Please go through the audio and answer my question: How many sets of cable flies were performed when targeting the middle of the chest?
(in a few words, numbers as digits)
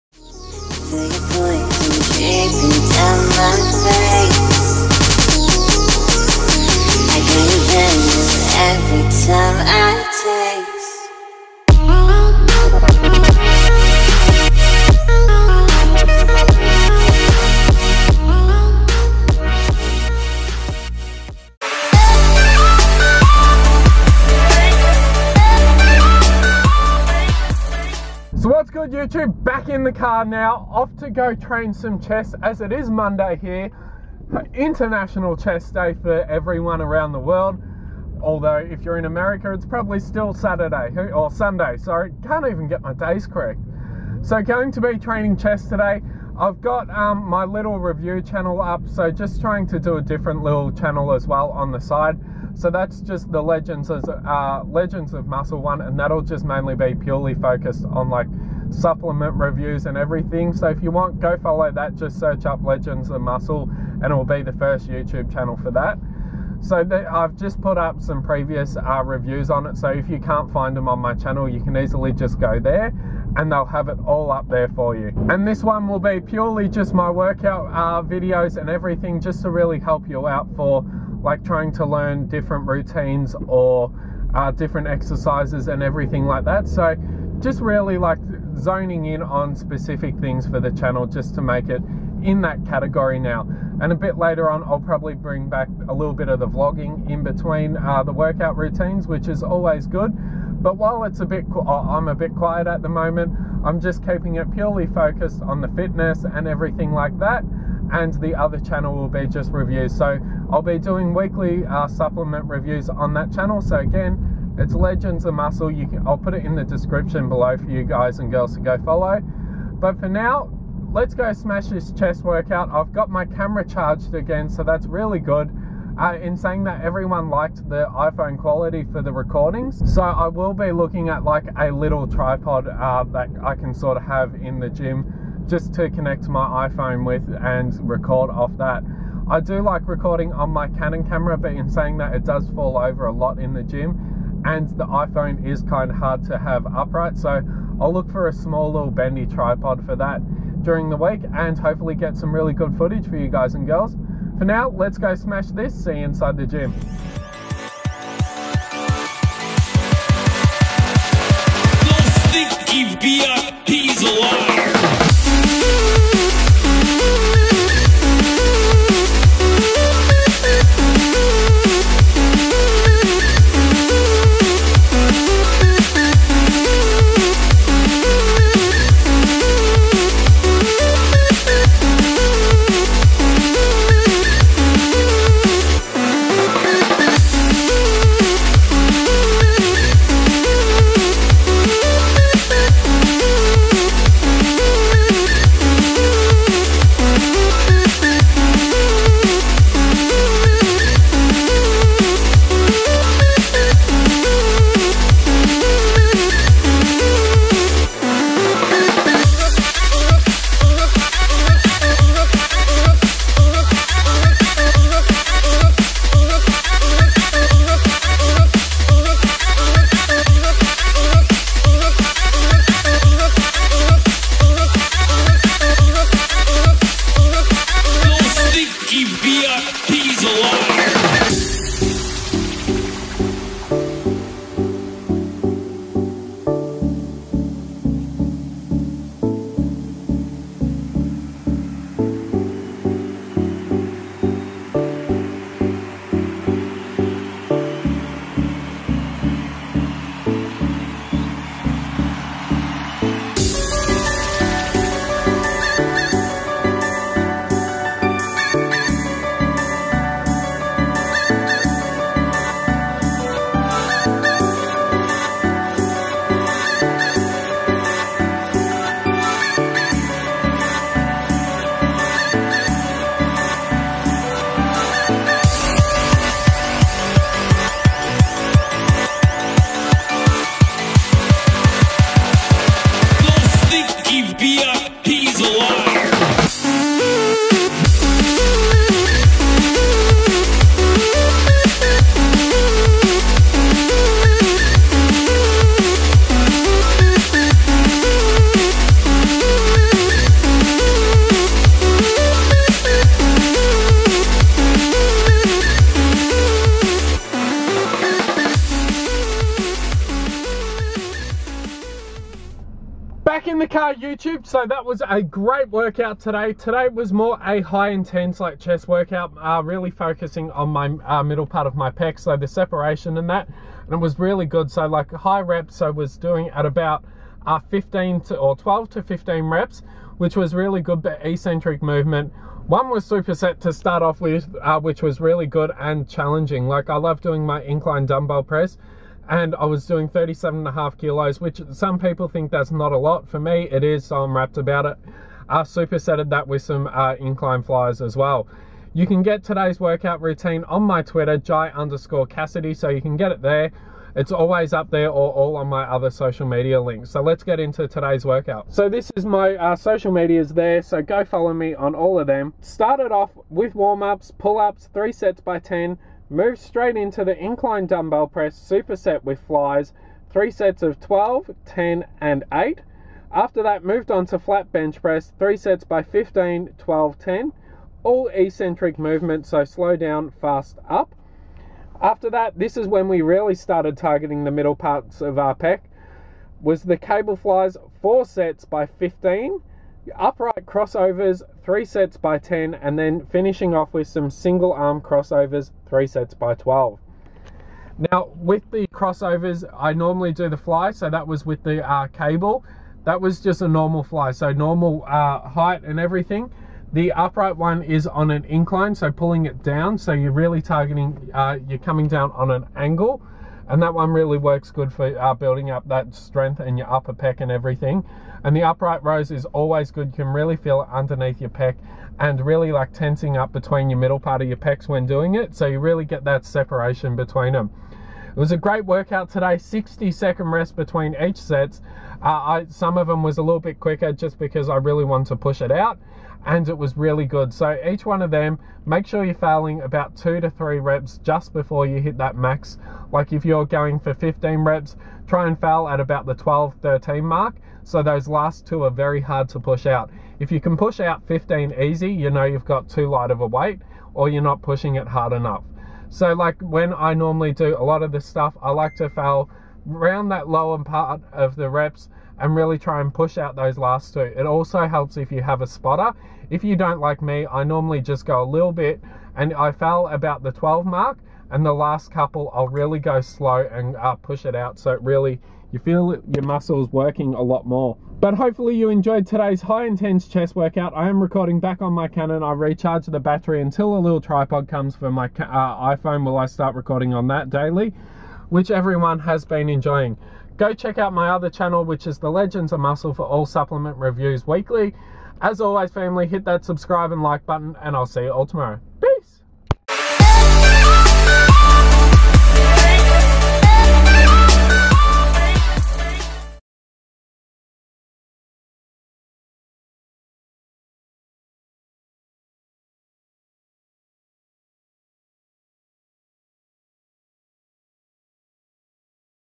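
4.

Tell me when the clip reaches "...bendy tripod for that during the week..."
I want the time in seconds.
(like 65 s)
148 s.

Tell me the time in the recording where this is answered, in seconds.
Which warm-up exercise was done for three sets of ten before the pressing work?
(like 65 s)
364 s.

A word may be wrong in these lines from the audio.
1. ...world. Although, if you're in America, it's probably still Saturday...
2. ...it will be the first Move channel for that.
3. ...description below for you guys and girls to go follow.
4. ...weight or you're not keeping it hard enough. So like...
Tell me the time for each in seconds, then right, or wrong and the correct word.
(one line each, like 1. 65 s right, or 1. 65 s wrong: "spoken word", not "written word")
1. 37 s right
2. 64 s wrong: "YouTube", not "Move"
3. 116 s right
4. 453 s wrong: "pushing", not "keeping".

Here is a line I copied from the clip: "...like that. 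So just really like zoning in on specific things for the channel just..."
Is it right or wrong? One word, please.
right.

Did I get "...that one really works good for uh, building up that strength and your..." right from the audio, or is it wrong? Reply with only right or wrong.
right.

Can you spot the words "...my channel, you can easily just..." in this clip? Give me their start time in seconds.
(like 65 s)
70 s.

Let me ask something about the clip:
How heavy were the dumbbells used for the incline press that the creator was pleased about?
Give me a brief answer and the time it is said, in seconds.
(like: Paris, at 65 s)
37.5 kilos, at 340 s.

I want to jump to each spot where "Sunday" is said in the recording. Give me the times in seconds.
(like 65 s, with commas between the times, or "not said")
41 s.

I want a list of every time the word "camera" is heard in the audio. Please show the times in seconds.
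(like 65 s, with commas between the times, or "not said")
123 s, 141 s.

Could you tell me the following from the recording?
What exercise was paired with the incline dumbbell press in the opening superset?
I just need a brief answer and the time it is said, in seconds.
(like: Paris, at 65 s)
Incline flies, at 347 s.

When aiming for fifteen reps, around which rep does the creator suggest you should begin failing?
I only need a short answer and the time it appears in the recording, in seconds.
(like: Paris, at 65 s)
12 to 13, at 446 s.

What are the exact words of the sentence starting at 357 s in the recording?
So let's get into today's workout.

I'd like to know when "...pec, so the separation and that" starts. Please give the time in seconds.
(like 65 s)
321 s.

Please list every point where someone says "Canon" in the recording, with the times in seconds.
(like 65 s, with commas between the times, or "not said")
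140 s, 482 s.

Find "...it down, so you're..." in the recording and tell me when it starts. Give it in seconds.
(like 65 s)
409 s.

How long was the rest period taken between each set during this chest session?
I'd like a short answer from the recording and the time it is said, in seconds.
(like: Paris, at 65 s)
60 seconds, at 429 s.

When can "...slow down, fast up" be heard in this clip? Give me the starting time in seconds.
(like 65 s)
379 s.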